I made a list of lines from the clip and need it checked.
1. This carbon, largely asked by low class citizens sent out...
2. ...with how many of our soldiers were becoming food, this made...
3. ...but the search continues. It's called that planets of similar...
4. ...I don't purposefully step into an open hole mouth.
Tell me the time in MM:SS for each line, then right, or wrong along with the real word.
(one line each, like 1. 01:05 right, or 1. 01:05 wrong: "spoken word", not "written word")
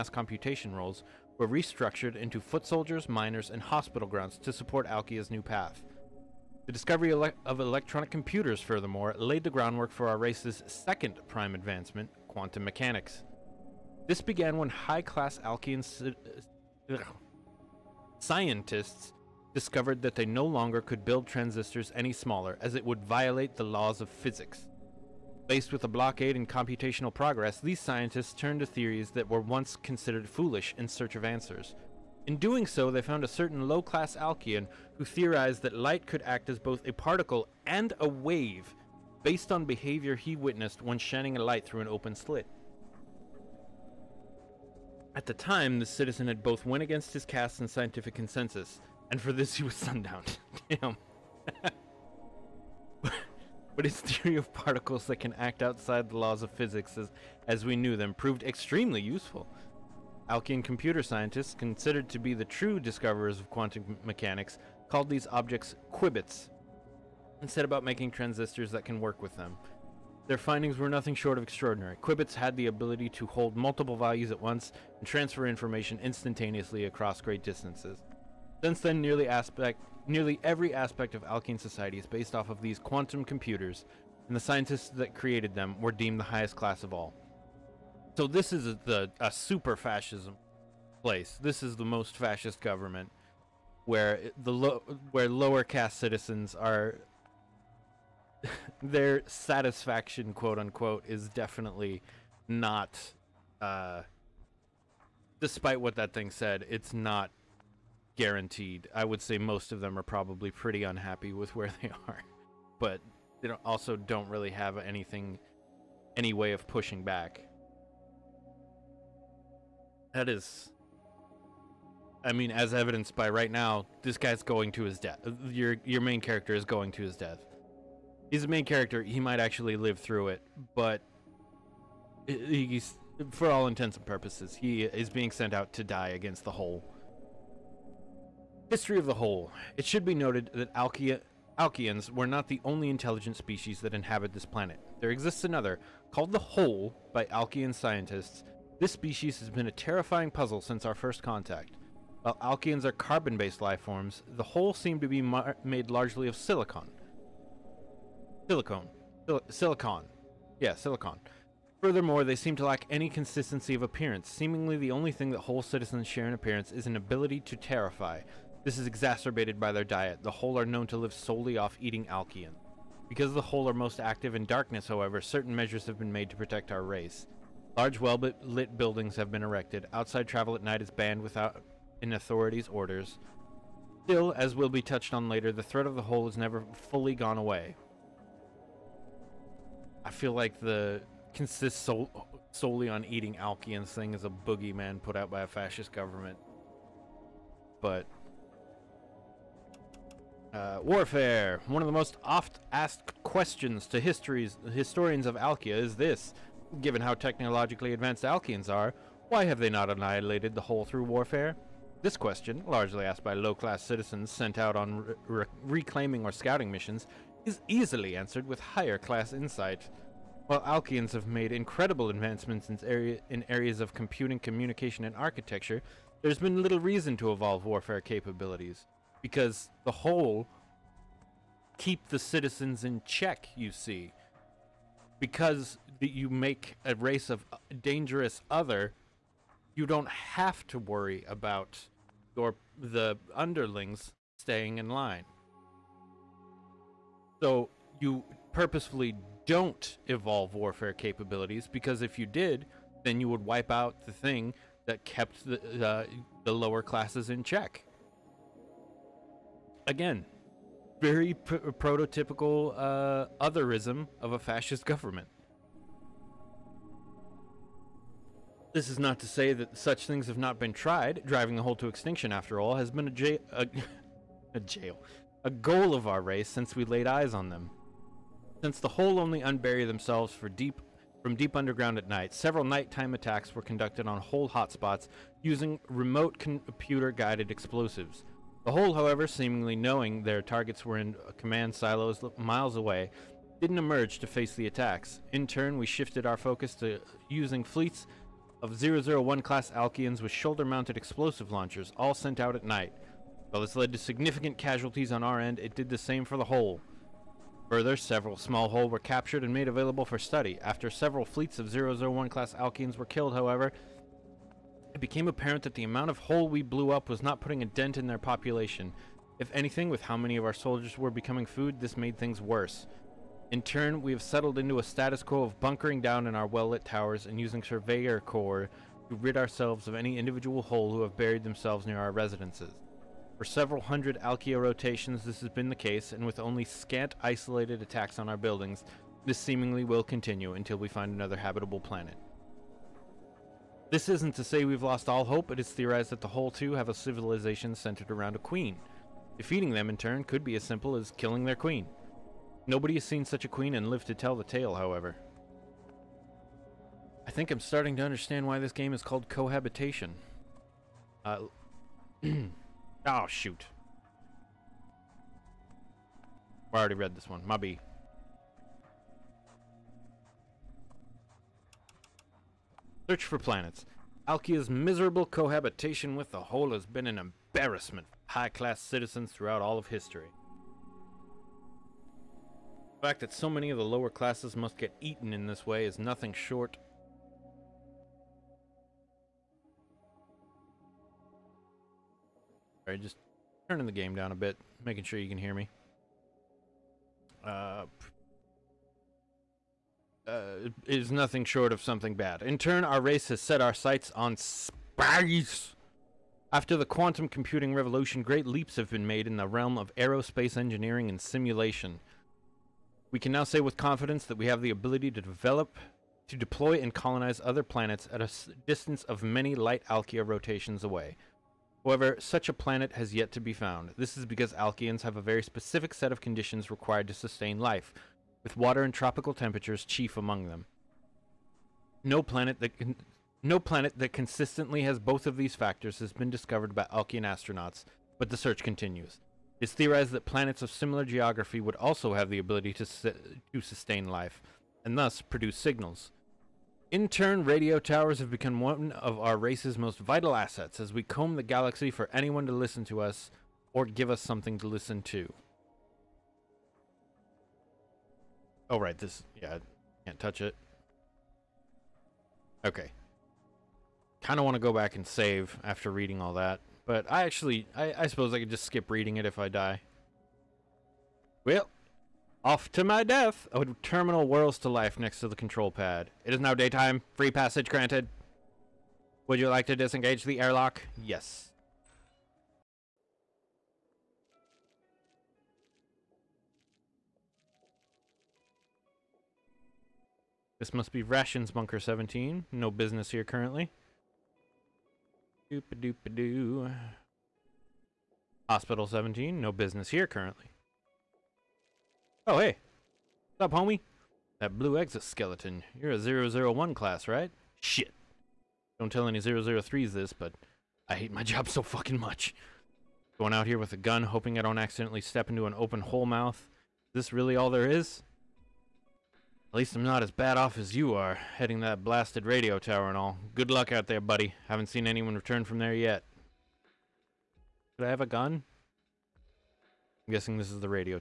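1. 03:32 wrong: "question", not "carbon"
2. 05:19 right
3. 07:18 wrong: "theorized", not "called"
4. 08:34 wrong: "accidentally", not "purposefully".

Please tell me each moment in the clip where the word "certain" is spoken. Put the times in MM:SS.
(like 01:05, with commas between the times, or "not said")
00:33, 02:55.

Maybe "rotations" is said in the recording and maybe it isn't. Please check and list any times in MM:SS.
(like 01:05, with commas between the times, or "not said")
05:34, 07:00.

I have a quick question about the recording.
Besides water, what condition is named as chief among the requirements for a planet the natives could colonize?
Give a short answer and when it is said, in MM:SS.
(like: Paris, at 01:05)
tropical temperatures, at 07:08.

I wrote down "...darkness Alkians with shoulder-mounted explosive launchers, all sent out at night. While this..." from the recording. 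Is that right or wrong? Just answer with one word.
wrong.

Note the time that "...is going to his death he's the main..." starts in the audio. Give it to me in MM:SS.
02:06.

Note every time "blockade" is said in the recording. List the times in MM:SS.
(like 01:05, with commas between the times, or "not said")
00:25.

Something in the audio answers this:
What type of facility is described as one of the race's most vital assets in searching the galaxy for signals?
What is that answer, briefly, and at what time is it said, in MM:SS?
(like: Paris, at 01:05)
radio towers, at 07:27.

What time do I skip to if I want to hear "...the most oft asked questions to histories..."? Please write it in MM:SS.
03:21.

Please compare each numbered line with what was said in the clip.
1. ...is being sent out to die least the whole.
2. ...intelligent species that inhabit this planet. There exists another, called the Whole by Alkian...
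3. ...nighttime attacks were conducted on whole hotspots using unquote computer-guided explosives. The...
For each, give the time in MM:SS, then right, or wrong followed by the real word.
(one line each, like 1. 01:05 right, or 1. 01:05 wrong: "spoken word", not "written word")
1. 02:14 wrong: "against", not "least"
2. 02:22 right
3. 04:42 wrong: "remote", not "unquote".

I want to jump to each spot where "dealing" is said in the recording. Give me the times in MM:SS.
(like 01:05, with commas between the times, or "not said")
not said.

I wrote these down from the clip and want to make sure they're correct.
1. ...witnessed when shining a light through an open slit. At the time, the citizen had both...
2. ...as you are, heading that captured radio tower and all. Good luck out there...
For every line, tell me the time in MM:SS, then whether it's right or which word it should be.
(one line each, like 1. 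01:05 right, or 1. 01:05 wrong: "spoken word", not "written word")
1. 00:40 right
2. 08:40 wrong: "blasted", not "captured".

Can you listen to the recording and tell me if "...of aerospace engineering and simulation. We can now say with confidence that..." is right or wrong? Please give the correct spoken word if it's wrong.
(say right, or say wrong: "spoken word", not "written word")
right.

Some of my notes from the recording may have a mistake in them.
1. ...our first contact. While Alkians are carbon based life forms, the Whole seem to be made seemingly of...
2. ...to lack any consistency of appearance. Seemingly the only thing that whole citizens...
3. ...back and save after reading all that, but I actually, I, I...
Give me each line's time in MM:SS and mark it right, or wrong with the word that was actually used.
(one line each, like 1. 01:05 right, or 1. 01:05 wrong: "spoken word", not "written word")
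1. 02:30 wrong: "largely", not "seemingly"
2. 02:42 right
3. 07:44 right.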